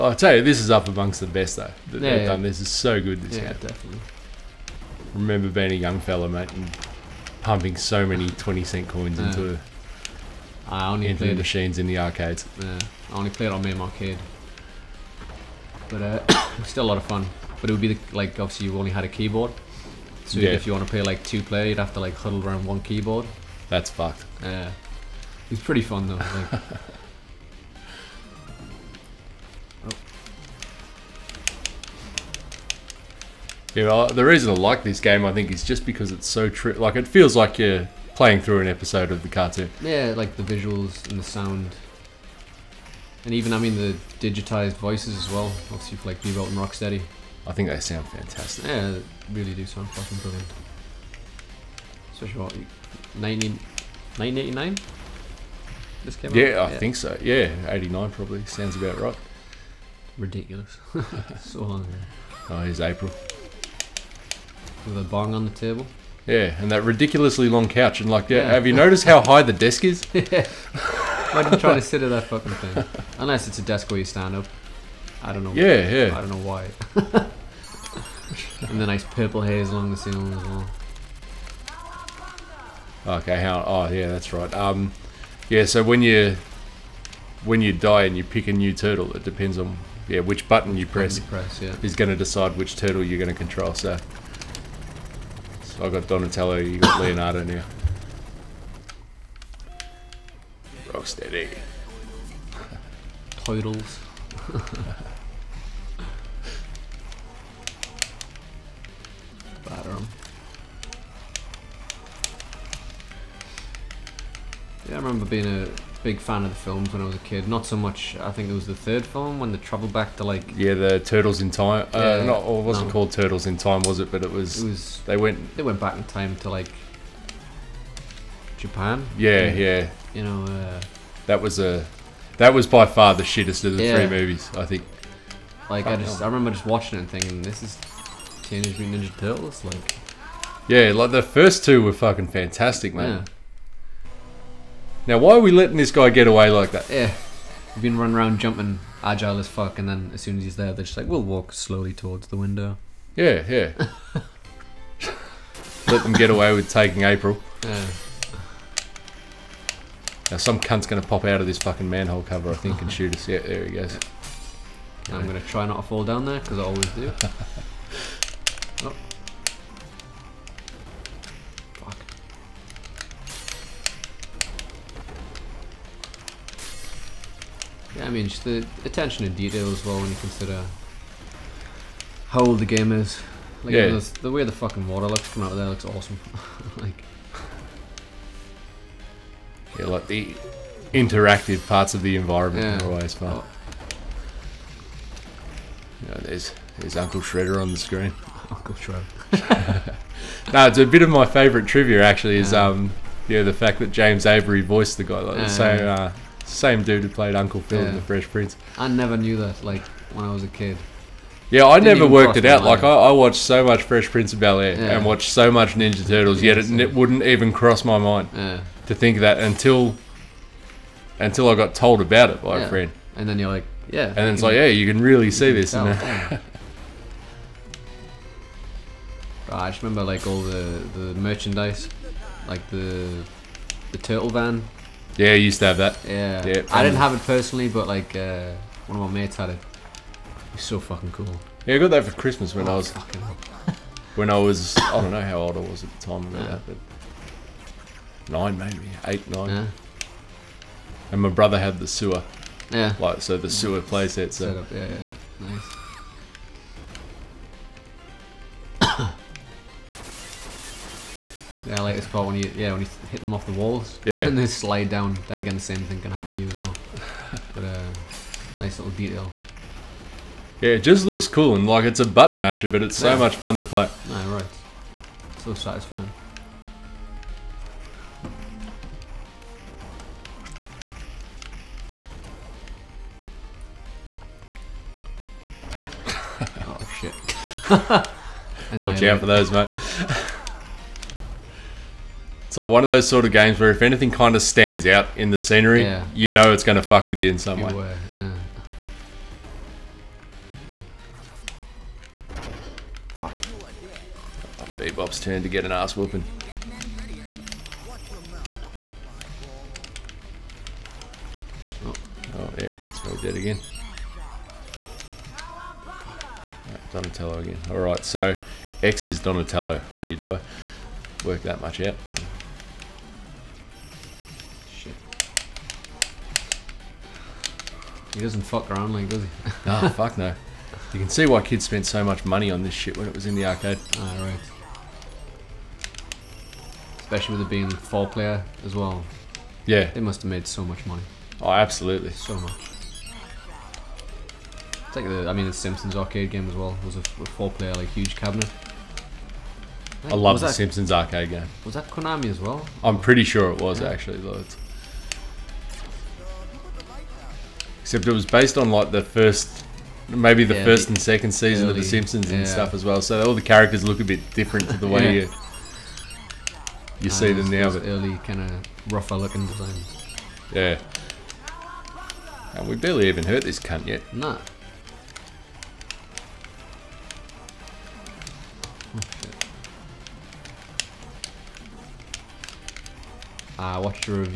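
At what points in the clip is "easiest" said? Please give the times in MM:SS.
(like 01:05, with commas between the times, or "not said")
not said.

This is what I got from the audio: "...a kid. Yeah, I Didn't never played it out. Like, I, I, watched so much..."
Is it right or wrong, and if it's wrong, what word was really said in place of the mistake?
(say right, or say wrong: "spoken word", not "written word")
wrong: "worked", not "played".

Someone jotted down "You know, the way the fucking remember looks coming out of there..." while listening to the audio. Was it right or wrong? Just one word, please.
wrong.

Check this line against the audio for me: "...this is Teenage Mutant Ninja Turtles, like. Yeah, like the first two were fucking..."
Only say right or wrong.
right.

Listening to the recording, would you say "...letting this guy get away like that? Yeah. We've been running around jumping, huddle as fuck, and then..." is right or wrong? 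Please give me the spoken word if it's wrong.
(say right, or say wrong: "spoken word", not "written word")
wrong: "agile", not "huddle".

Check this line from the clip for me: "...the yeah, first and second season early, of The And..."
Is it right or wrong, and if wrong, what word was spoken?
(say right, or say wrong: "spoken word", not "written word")
wrong: "Simpsons", not "And".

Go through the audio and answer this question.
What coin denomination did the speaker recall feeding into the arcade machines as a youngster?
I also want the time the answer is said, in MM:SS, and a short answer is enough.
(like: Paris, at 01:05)
20 cent, at 00:08.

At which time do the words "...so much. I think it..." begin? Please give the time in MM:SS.
01:57.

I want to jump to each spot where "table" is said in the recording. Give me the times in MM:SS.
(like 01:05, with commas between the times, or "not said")
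01:05.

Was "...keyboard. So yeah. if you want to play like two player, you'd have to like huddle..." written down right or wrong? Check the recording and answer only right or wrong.
right.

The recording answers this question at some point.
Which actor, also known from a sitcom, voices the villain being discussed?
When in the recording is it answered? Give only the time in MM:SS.
03:23.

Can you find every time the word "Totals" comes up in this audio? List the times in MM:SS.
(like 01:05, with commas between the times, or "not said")
01:43.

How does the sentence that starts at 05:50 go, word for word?
I, I love the that, Simpsons arcade game.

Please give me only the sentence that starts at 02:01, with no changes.
Uh, yeah, not, or it wasn't no.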